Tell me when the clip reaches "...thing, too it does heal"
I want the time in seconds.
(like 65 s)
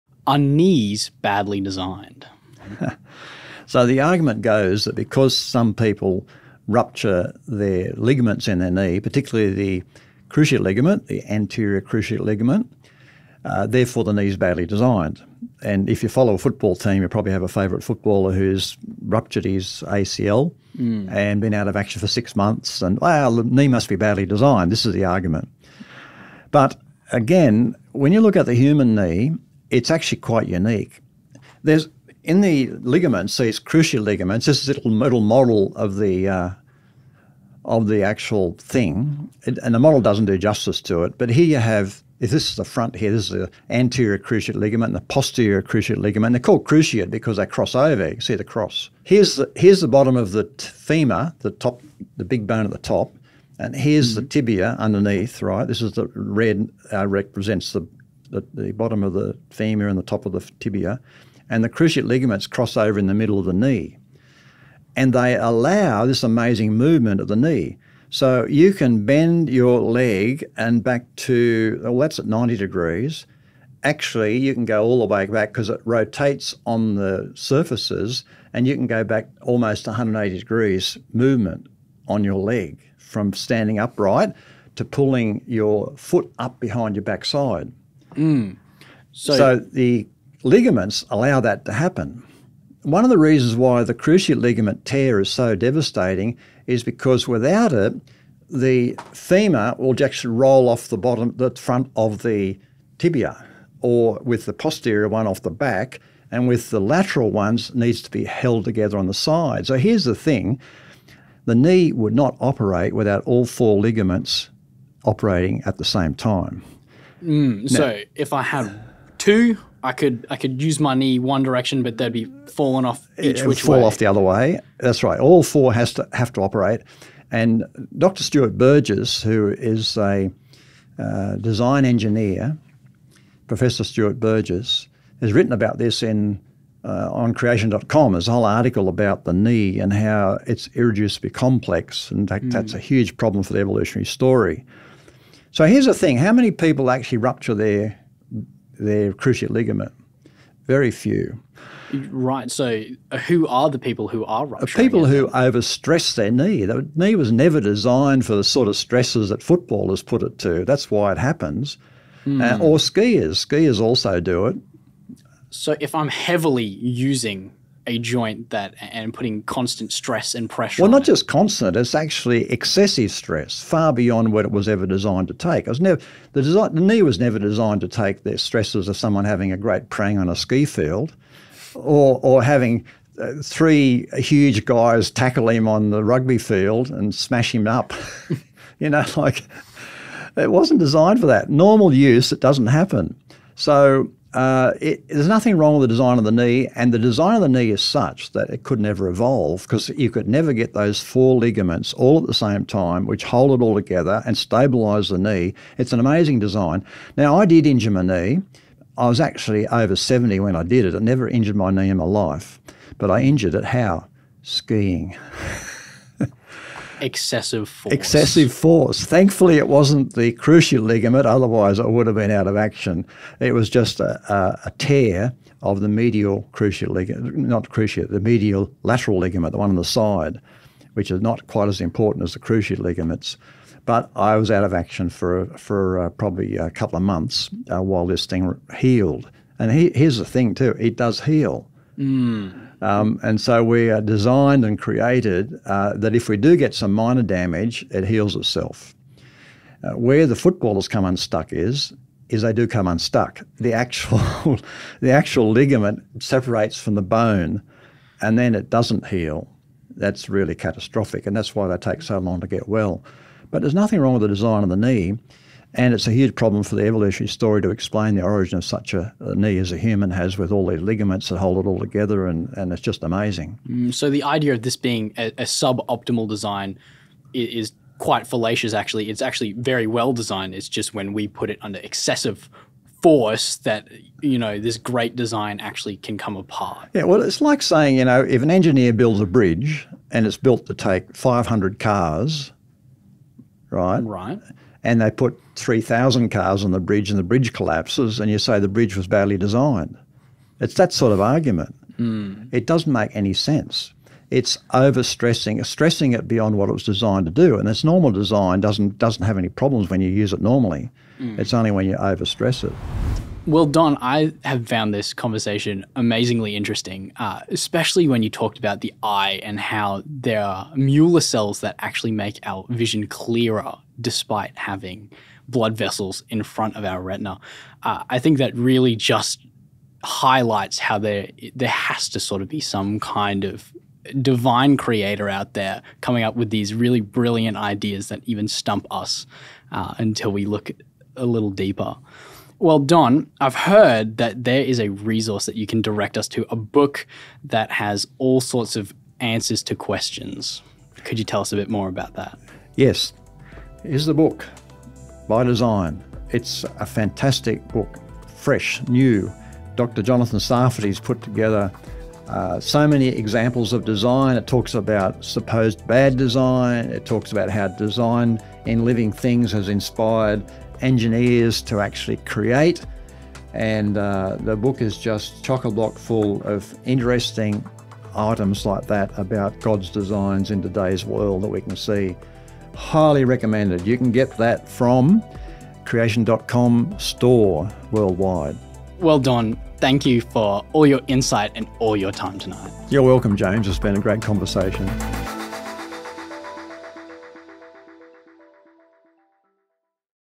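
240 s.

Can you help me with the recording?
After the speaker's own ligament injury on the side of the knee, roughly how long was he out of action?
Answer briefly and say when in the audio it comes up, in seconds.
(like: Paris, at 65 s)
A couple of months, at 236 s.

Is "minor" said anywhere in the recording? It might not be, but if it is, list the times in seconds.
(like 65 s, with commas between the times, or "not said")
246 s.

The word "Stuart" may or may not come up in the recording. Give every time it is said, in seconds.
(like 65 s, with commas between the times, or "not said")
128 s, 133 s.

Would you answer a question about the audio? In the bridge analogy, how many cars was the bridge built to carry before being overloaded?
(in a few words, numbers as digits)
500.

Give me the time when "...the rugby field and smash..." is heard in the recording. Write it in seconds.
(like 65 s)
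185 s.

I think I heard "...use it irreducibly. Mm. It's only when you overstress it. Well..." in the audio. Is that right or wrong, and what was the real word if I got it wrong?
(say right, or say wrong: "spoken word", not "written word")
wrong: "normally", not "irreducibly".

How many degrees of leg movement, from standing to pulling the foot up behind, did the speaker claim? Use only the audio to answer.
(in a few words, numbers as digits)
180 degrees.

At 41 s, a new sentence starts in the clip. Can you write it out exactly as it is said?
But here you have if this is the front here, this is the anterior cruciate ligament, and the posterior cruciate ligament.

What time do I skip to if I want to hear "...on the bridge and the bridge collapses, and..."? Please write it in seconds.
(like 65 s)
296 s.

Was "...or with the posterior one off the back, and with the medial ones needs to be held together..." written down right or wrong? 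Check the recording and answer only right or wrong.
wrong.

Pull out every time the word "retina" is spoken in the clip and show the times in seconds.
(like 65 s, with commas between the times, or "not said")
327 s.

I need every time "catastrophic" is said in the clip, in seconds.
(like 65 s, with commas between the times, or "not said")
260 s.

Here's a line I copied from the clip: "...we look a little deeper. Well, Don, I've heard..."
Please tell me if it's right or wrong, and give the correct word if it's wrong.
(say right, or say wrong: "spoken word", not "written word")
right.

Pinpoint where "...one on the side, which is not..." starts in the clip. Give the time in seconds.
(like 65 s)
229 s.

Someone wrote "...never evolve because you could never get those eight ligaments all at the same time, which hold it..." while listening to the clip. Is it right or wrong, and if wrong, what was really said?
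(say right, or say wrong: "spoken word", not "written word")
wrong: "four", not "eight".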